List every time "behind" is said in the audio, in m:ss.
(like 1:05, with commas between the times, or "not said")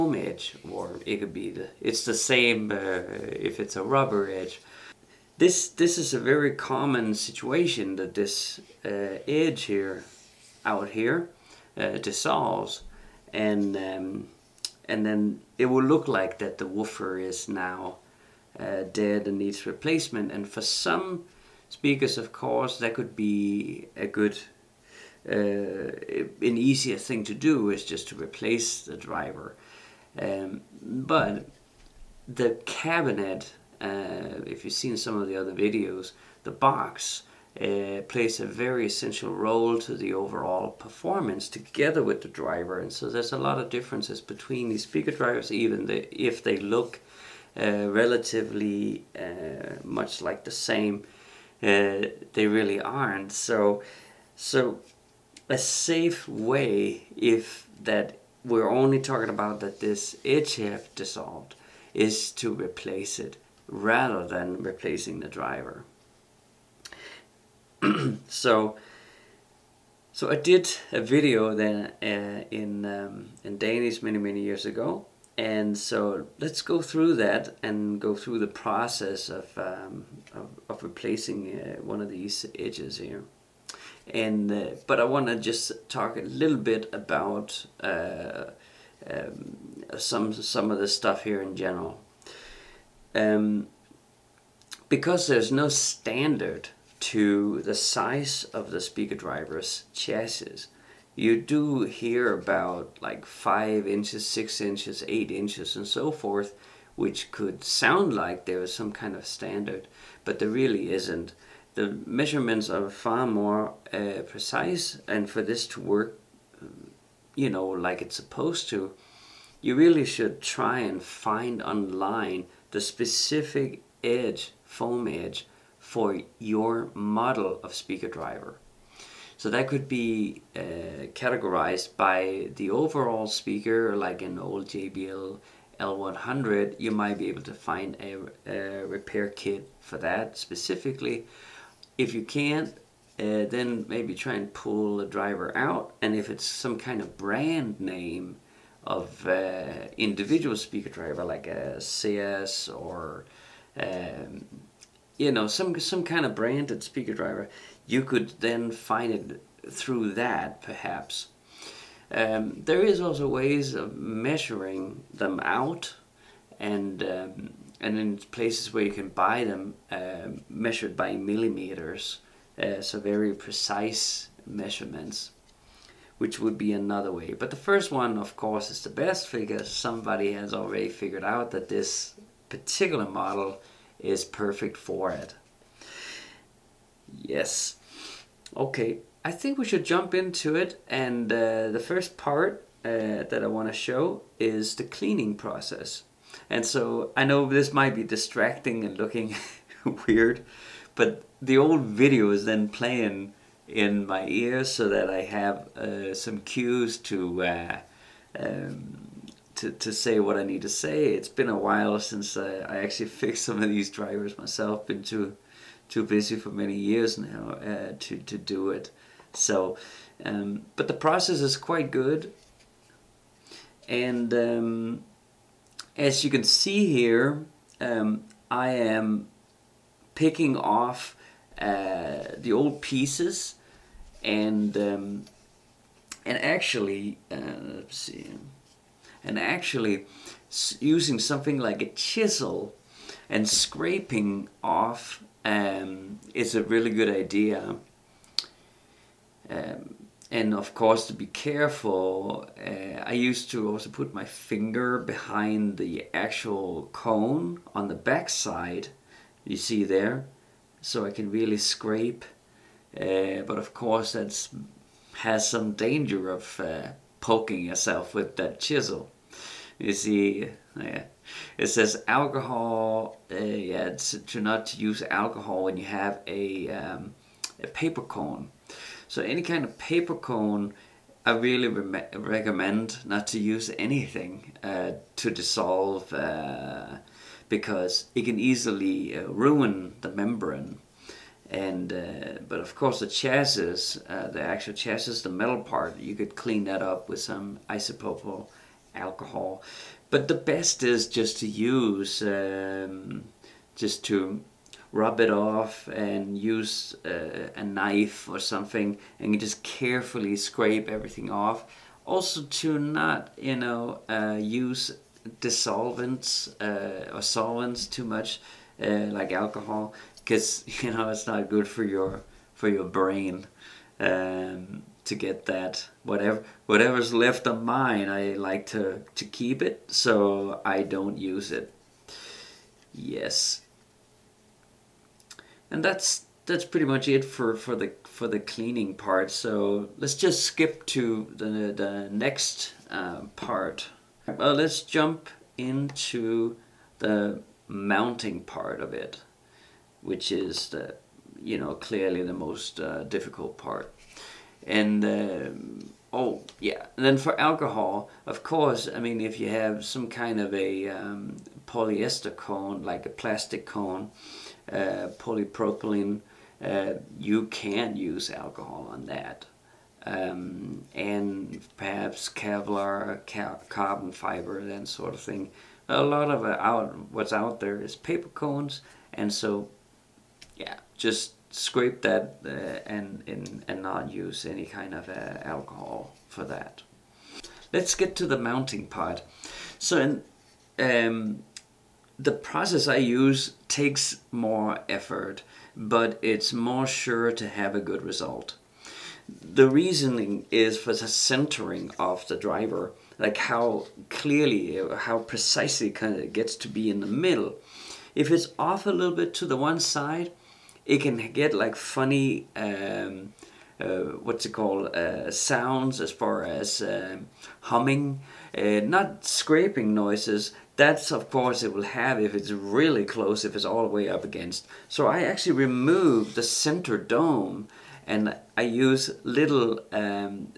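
4:14.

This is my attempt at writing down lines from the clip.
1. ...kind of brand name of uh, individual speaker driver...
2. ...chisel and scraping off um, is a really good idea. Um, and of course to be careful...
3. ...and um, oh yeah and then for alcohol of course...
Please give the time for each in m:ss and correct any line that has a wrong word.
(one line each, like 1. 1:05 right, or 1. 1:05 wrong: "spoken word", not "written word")
1. 2:26 right
2. 4:01 right
3. 5:54 right.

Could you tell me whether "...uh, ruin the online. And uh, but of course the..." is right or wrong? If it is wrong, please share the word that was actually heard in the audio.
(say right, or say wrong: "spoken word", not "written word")
wrong: "membrane", not "online".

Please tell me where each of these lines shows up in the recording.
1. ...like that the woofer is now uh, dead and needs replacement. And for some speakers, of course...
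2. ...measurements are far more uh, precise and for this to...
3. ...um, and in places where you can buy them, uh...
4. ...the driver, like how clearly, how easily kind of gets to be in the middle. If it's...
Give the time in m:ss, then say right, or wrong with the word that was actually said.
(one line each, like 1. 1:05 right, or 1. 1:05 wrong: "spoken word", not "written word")
1. 0:16 right
2. 1:52 right
3. 2:47 right
4. 6:42 wrong: "precisely", not "easily".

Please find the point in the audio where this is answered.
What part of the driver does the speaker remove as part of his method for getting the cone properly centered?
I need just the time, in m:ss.
7:06.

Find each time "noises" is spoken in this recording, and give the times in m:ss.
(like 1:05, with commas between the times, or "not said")
6:59.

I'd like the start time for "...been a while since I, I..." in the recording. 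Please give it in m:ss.
3:31.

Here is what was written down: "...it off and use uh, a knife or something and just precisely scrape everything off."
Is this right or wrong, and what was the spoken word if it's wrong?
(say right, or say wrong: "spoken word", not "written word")
wrong: "carefully", not "precisely".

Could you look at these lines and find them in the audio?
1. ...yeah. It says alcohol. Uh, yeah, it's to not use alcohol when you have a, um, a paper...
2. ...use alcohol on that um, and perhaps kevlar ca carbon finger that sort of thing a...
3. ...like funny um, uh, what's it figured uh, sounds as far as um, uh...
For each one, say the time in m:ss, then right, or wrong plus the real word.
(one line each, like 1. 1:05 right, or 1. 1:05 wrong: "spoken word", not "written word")
1. 4:30 right
2. 6:07 wrong: "fiber", not "finger"
3. 6:51 wrong: "called", not "figured".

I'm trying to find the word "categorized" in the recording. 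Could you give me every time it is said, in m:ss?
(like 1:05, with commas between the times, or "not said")
2:11.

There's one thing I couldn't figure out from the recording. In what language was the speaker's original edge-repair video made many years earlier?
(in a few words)
Danish.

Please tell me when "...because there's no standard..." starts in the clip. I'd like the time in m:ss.
1:34.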